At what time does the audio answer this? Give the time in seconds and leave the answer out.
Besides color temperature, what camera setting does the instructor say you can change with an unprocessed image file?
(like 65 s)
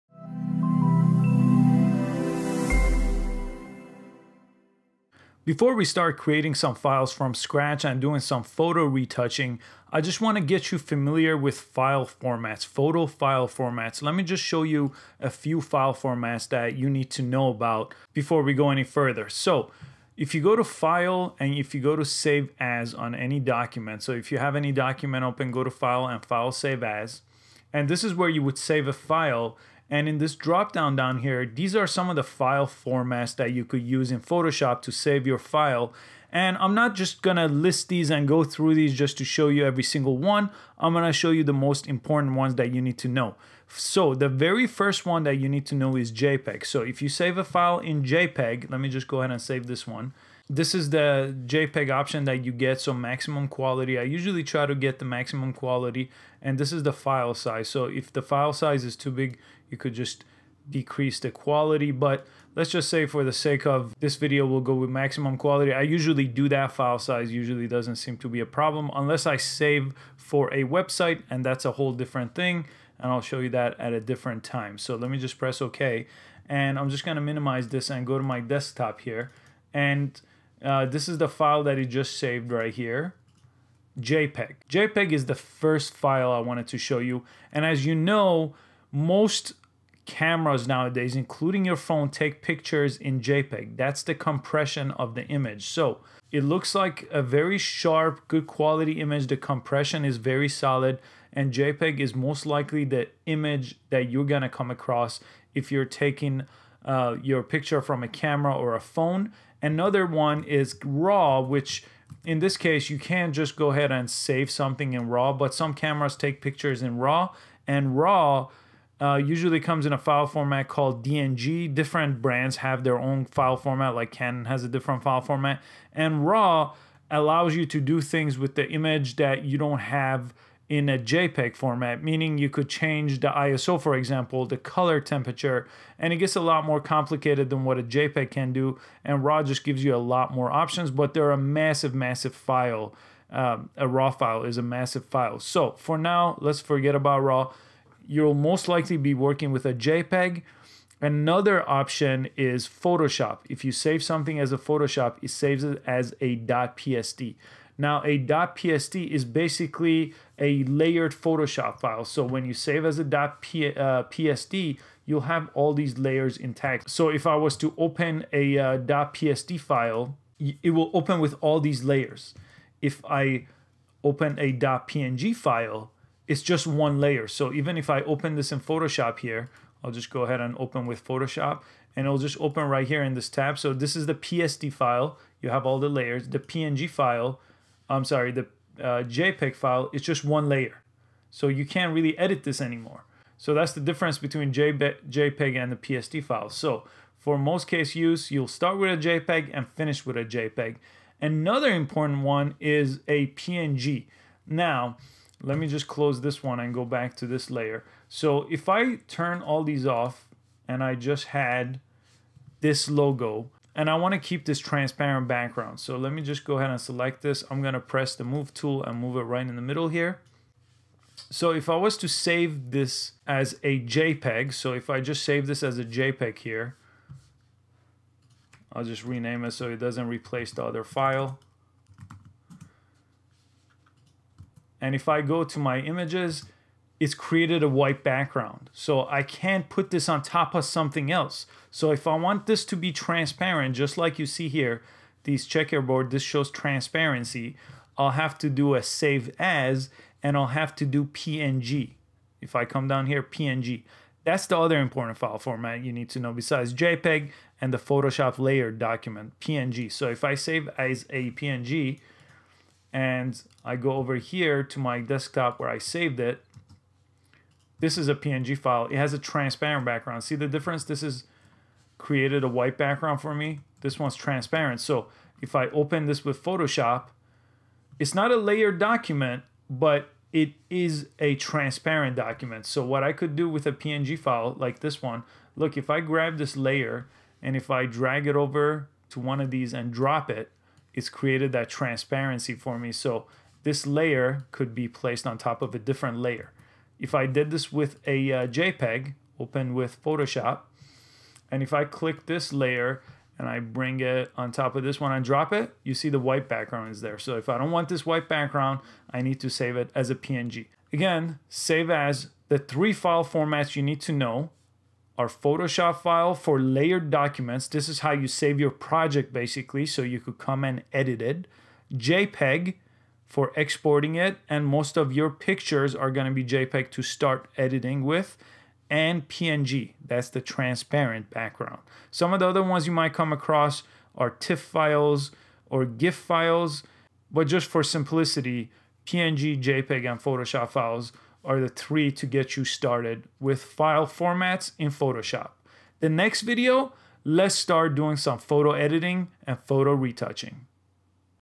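133 s.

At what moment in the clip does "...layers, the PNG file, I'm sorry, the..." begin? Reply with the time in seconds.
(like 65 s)
185 s.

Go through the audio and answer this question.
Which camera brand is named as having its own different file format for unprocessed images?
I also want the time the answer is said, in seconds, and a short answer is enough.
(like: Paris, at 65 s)
Canon, at 124 s.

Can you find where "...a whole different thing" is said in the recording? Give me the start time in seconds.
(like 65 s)
71 s.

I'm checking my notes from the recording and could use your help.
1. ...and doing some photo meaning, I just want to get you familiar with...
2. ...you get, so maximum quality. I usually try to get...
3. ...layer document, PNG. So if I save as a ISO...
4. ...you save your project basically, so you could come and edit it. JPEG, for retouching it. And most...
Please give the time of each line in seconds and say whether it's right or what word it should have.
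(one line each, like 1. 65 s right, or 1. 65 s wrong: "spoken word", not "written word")
1. 7 s wrong: "retouching", not "meaning"
2. 52 s right
3. 258 s wrong: "PNG", not "ISO"
4. 318 s wrong: "exporting", not "retouching".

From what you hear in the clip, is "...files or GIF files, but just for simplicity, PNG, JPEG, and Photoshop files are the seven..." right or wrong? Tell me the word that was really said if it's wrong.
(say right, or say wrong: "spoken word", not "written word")
wrong: "three", not "seven".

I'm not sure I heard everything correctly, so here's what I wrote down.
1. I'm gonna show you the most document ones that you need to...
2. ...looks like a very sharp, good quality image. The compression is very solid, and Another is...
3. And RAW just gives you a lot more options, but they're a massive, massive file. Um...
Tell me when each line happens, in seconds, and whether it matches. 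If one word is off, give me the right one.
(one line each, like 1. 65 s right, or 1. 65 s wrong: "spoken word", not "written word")
1. 40 s wrong: "important", not "document"
2. 96 s wrong: "JPEG", not "Another"
3. 139 s right.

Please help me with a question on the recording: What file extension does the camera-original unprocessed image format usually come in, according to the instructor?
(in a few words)
DNG.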